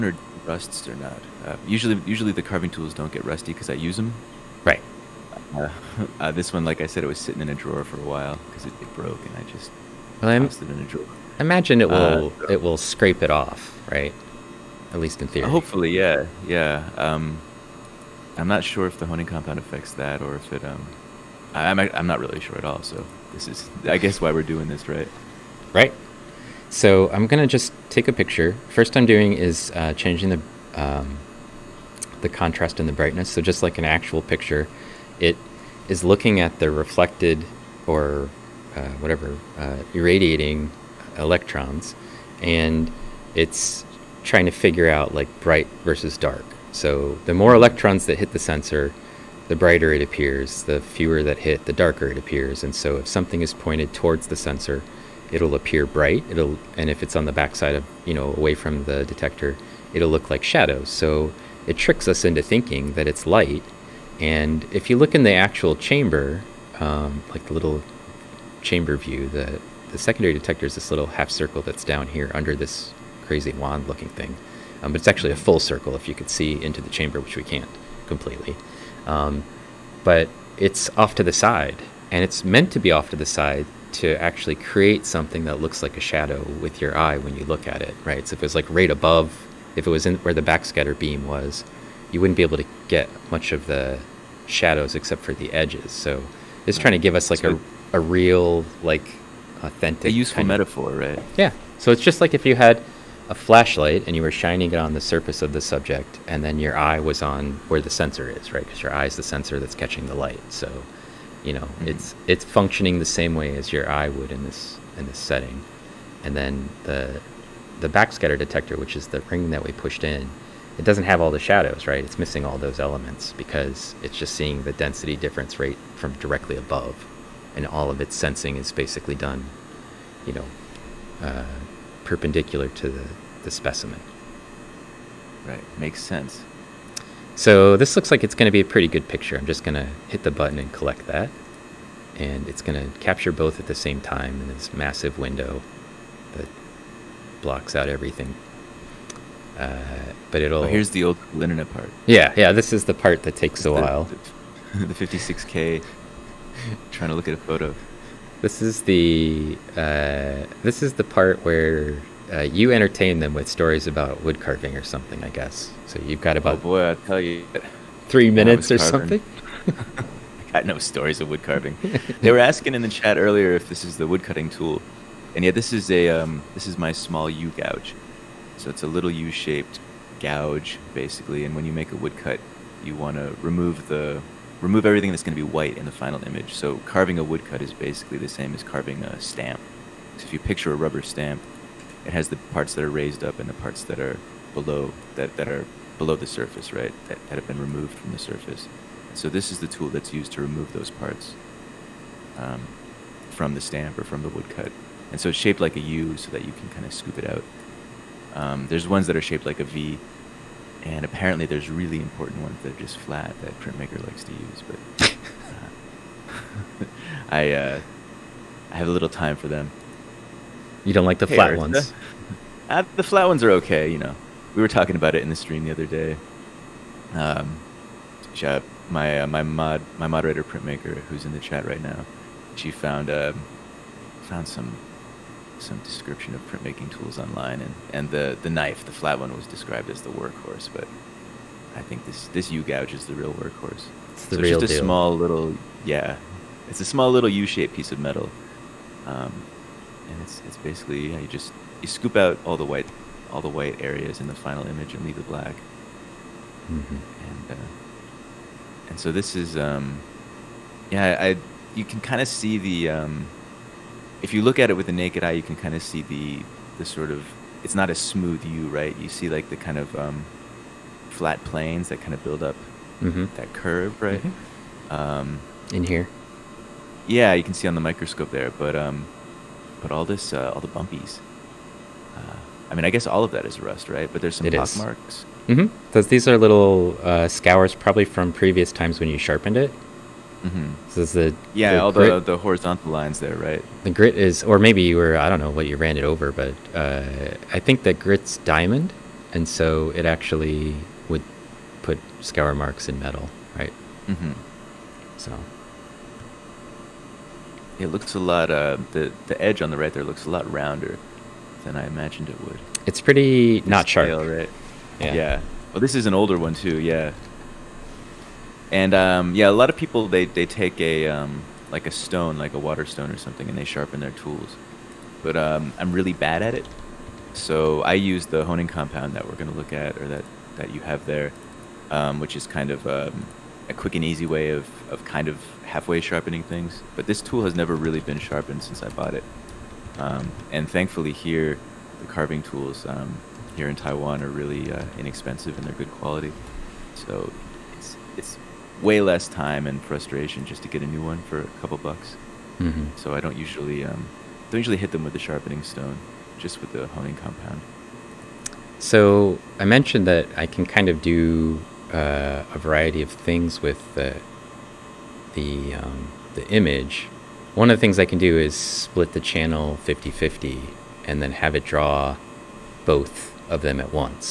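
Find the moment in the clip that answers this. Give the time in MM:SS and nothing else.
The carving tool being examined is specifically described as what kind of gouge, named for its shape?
02:56.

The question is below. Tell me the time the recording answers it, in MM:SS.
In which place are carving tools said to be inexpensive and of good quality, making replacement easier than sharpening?
05:43.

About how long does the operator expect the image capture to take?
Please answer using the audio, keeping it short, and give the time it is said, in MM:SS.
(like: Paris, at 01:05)
3 minutes, at 02:48.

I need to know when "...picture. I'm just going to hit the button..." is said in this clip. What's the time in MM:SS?
02:19.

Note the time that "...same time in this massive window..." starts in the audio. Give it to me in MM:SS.
02:23.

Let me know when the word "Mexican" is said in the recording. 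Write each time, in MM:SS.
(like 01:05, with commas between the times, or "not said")
not said.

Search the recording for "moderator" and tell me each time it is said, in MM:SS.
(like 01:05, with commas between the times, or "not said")
03:50.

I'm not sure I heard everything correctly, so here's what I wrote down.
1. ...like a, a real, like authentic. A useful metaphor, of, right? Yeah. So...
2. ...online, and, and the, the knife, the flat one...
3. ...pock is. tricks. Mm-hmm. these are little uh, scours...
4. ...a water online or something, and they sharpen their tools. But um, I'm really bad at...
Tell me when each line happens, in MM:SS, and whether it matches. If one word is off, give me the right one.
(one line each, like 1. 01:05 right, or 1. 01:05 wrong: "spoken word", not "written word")
1. 01:37 right
2. 03:57 right
3. 04:44 wrong: "marks", not "tricks"
4. 05:22 wrong: "stone", not "online".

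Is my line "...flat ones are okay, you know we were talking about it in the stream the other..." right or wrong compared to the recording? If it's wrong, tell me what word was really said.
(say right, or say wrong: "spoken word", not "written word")
right.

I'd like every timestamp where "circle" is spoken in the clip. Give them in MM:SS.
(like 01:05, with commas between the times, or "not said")
01:11, 01:15.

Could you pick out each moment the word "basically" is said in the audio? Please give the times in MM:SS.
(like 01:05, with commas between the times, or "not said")
02:08, 03:00, 03:07, 04:10.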